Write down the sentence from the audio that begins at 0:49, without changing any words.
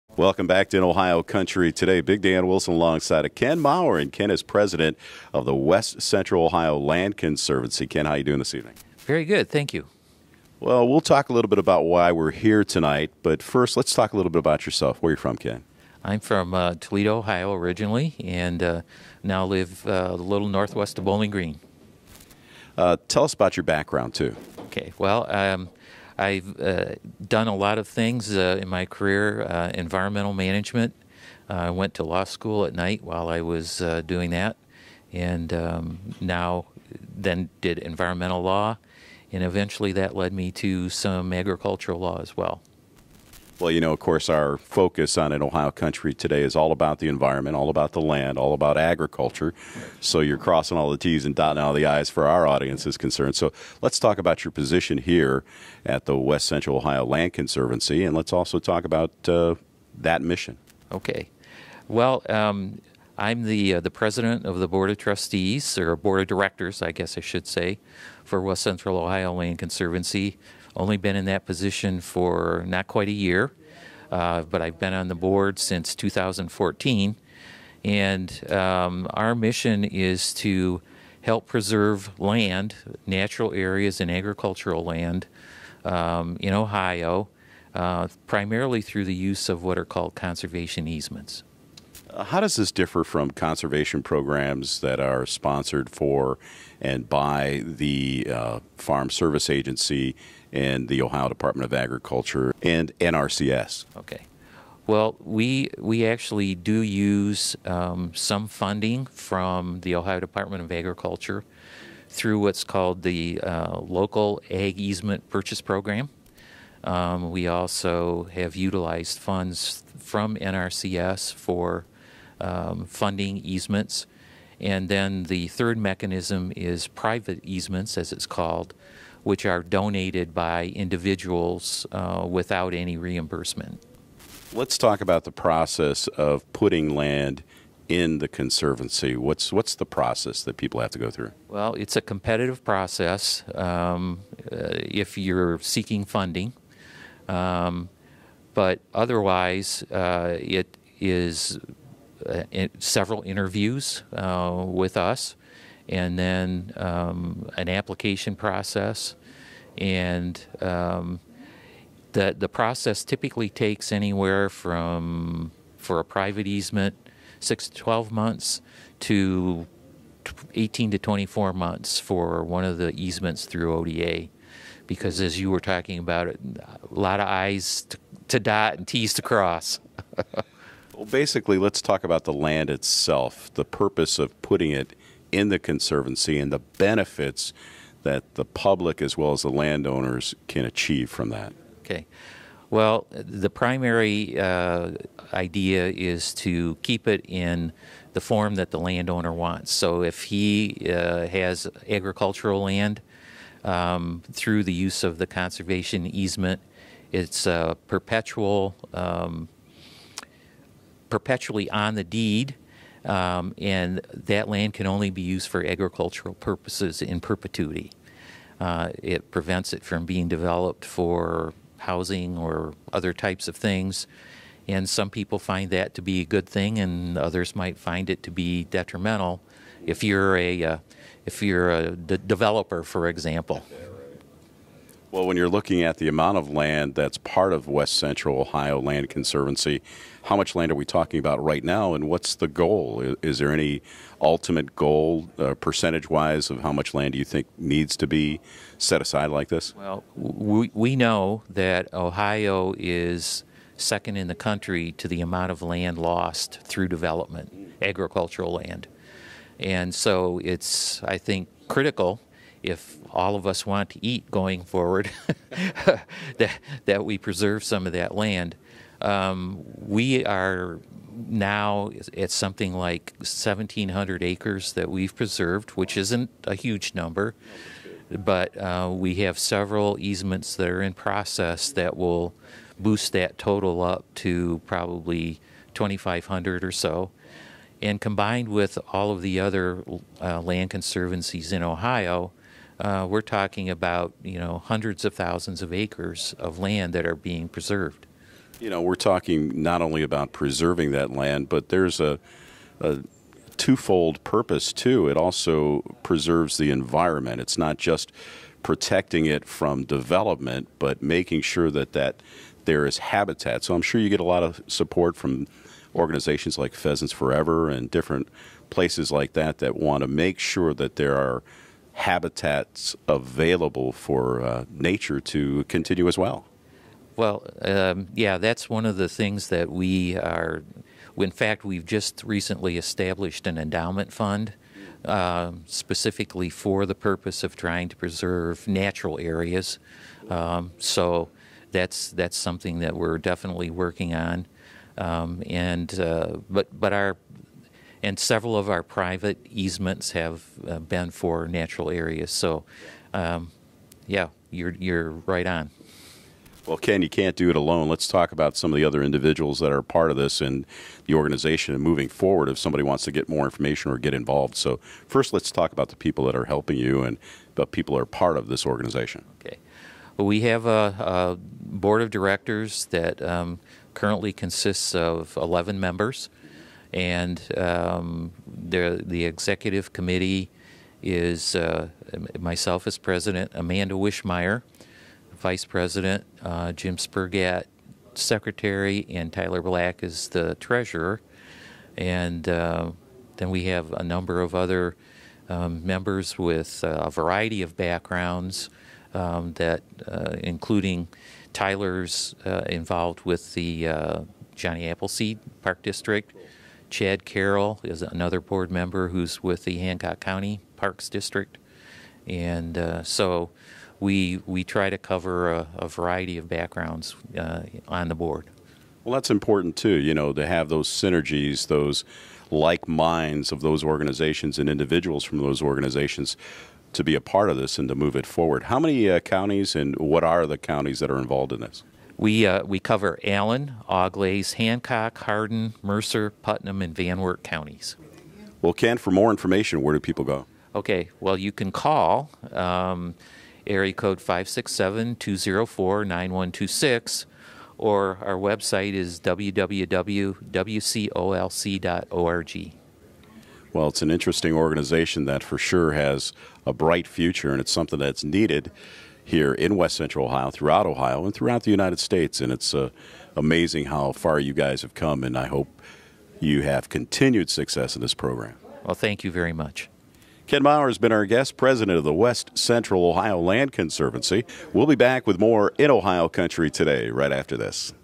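So you're crossing all the T's and dotting all the I's for our audience is concerned.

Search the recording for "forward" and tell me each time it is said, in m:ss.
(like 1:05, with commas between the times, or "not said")
4:24, 6:02, 7:08.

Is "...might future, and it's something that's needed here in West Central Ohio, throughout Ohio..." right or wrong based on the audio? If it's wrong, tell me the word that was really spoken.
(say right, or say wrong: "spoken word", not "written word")
wrong: "bright", not "might".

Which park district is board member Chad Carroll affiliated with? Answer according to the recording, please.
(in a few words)
Hancock County Parks District.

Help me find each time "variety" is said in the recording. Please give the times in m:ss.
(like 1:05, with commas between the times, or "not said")
6:37, 6:55.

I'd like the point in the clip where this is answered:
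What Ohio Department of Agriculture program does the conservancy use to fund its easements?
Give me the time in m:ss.
1:53.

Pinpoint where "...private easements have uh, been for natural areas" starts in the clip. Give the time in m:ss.
5:48.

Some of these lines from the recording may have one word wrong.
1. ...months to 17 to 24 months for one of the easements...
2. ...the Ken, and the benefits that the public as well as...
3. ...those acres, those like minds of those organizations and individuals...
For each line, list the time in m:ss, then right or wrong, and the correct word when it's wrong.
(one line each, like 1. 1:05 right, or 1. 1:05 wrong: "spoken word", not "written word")
1. 2:48 wrong: "18", not "17"
2. 3:05 wrong: "Conservancy", not "Ken"
3. 7:00 wrong: "synergies", not "acres".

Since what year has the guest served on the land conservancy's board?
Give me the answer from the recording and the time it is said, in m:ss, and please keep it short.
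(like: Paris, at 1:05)
2014, at 1:15.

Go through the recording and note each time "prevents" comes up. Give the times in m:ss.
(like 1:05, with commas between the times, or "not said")
3:39.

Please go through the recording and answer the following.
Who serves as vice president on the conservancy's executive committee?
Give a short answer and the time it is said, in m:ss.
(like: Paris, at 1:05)
Amanda Wishmeyer, at 6:23.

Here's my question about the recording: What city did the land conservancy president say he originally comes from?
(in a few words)
Toledo.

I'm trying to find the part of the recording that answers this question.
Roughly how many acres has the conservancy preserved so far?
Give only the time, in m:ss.
4:33.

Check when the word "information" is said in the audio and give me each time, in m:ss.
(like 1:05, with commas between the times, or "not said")
6:03, 7:19.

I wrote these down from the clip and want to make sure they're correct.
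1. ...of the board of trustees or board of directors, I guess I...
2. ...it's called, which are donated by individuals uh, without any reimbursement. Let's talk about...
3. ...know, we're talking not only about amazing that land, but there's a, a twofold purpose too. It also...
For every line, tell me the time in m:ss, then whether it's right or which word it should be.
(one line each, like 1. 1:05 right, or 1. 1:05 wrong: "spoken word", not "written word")
1. 1:04 right
2. 2:08 right
3. 4:58 wrong: "preserving", not "amazing".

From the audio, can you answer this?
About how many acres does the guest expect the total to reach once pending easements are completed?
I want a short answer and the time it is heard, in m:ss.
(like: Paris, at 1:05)
2,500, at 4:45.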